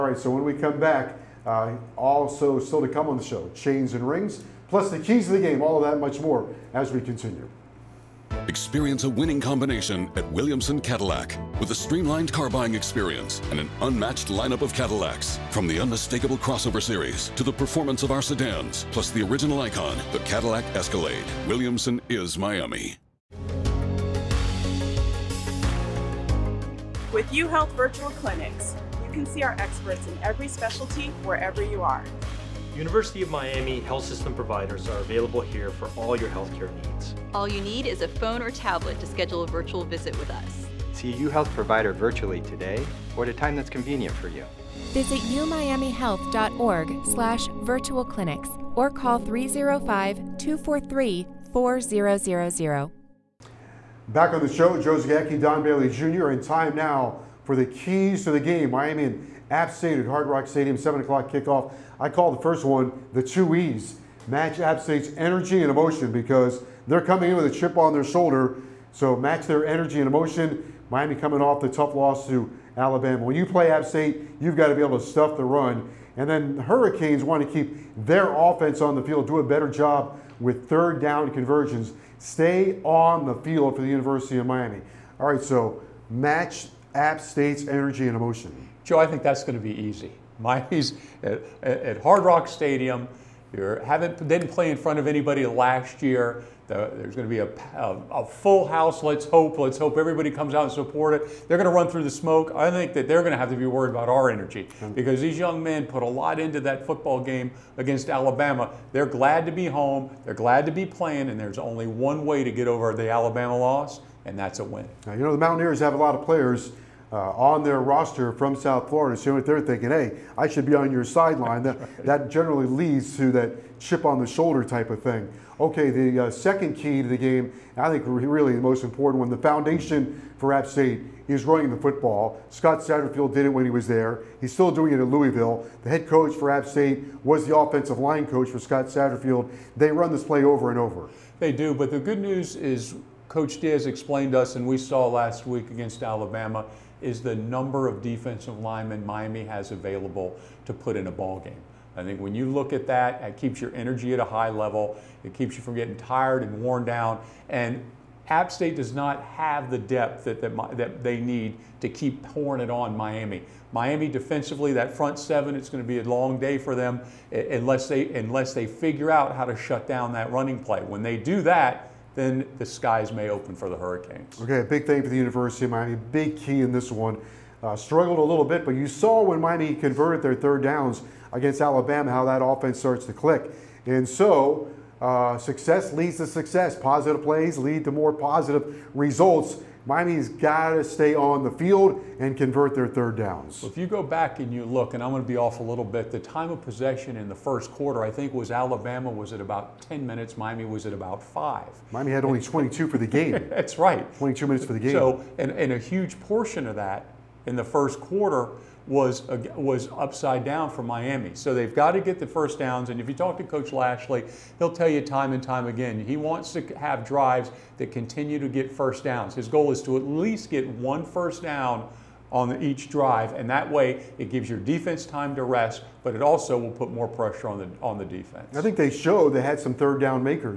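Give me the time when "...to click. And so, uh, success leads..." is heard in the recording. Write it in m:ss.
3:03.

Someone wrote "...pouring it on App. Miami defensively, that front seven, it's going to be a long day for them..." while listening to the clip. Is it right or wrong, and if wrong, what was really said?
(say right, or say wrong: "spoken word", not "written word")
wrong: "Miami", not "App".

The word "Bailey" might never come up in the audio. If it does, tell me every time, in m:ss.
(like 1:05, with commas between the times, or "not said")
0:55.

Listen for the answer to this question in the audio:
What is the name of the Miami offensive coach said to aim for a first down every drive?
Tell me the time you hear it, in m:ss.
3:33.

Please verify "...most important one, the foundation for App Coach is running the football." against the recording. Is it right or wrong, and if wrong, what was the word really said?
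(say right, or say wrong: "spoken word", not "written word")
wrong: "State", not "Coach".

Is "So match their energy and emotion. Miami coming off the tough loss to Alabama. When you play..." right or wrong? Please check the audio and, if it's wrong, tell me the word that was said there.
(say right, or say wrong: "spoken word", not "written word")
right.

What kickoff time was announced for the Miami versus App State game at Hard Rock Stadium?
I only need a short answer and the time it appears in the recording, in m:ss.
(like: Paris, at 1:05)
7 o'clock, at 1:00.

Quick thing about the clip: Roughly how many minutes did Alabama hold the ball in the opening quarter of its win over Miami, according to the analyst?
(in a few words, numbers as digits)
10 minutes.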